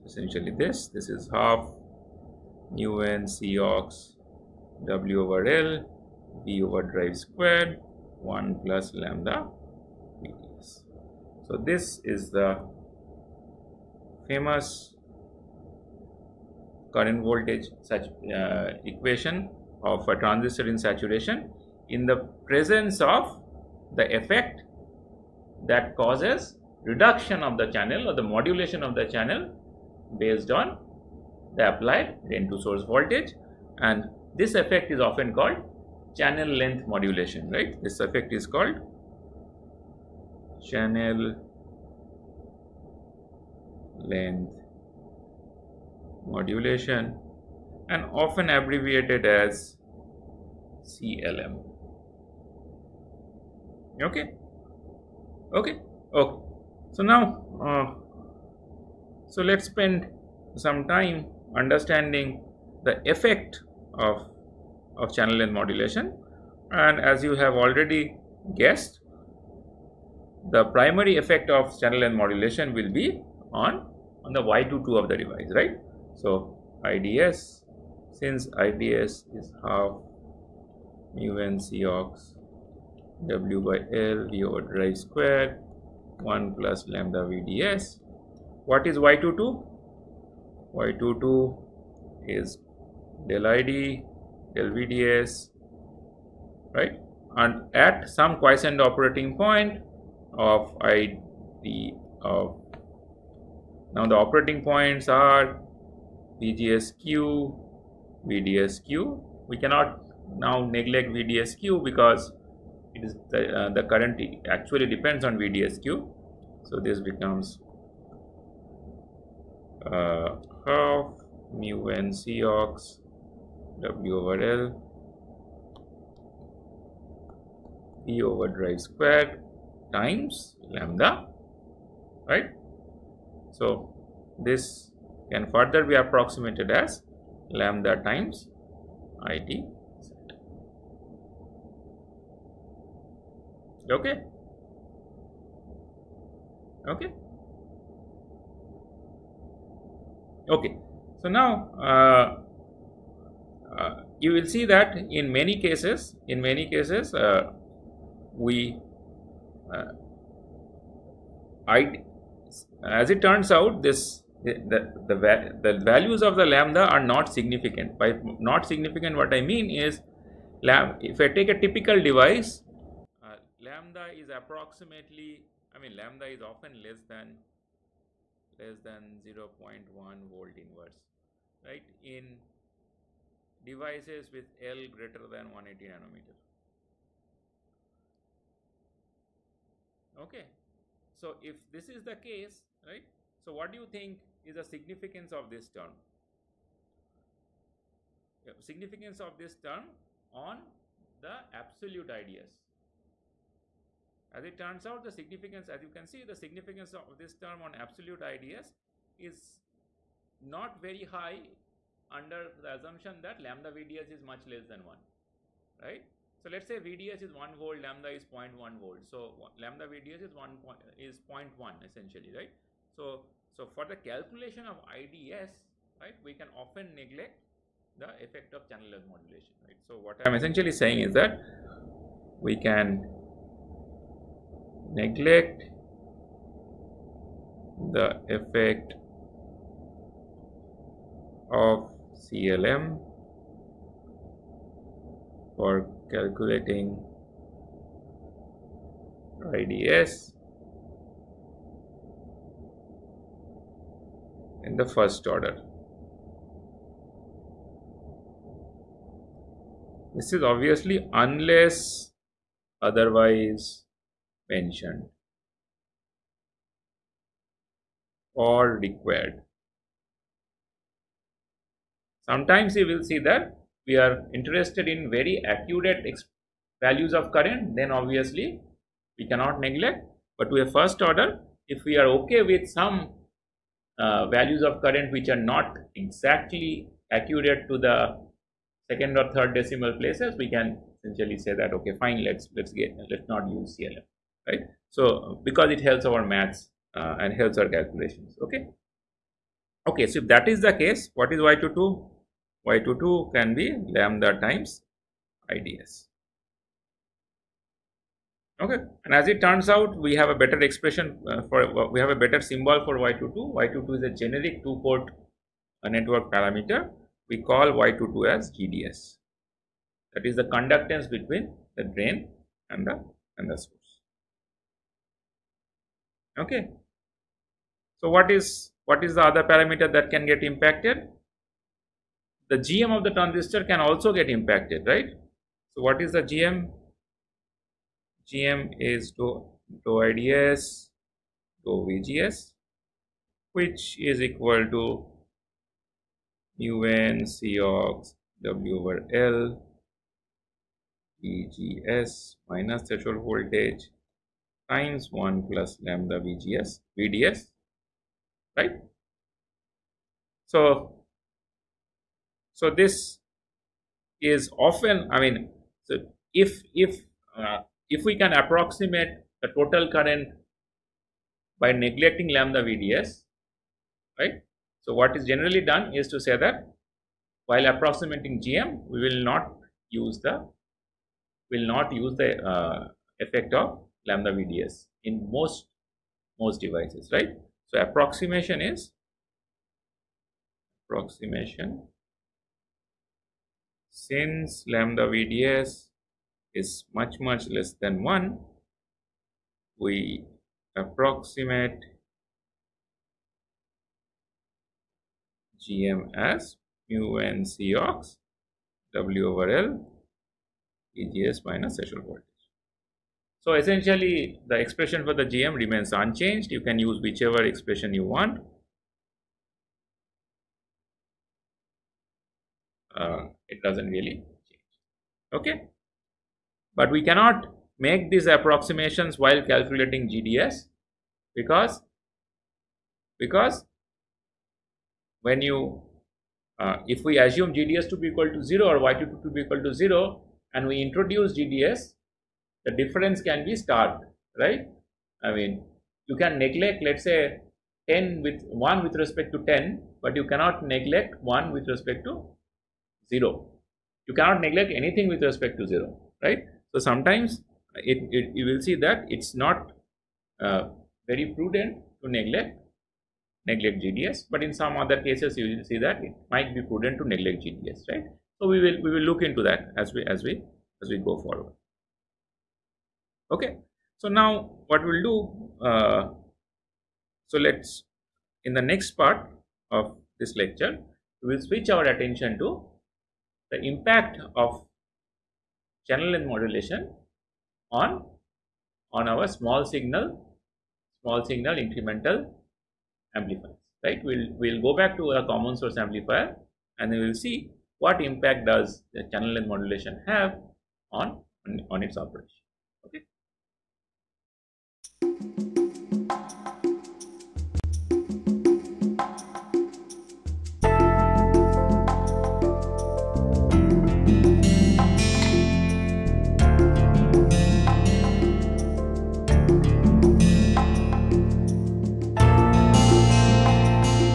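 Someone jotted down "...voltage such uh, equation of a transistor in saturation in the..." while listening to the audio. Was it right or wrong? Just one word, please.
right.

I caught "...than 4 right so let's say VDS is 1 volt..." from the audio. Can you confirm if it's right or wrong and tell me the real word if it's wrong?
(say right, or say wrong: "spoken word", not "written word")
wrong: "1", not "4".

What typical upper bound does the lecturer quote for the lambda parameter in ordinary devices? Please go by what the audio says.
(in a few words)
0.1 volt inverse.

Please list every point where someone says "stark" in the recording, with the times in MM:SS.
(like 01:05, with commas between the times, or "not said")
07:23.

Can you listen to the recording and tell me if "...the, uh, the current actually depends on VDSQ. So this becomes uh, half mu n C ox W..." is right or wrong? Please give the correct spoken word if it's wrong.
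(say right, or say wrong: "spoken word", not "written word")
right.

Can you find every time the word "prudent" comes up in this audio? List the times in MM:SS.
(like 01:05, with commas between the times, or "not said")
07:41, 07:46.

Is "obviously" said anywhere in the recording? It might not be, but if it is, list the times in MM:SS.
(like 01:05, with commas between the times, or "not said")
04:20, 04:37.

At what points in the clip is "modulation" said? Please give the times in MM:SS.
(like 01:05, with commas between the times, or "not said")
00:28, 00:36, 00:46, 01:05, 01:12, 03:49, 08:06, 08:19.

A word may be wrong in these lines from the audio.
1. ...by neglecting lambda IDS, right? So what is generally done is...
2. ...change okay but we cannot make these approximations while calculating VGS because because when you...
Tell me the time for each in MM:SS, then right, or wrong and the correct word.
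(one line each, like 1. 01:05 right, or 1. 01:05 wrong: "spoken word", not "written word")
1. 06:11 wrong: "VDS", not "IDS"
2. 07:04 wrong: "GDS", not "VGS".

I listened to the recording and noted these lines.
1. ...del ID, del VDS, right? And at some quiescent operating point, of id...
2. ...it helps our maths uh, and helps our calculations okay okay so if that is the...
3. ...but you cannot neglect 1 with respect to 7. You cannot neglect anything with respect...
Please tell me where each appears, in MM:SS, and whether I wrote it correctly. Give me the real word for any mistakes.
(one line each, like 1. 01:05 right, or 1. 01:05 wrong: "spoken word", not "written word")
1. 01:33 right
2. 04:55 right
3. 07:30 wrong: "0", not "7".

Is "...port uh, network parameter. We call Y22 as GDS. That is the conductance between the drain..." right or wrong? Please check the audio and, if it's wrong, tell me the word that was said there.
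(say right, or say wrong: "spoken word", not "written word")
right.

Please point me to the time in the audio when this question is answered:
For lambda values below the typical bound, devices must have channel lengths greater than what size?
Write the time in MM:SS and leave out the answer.
03:05.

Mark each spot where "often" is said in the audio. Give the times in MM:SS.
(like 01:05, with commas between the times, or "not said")
00:35, 00:48, 02:56, 03:46, 06:04.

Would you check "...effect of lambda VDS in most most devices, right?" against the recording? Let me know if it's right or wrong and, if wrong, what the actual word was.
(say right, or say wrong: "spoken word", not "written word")
right.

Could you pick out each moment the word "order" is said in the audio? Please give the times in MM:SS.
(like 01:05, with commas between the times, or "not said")
04:15, 04:41.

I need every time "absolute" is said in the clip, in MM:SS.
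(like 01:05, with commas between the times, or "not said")
03:21, 03:27.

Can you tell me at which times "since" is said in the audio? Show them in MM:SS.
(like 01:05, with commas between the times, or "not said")
01:18, 06:33.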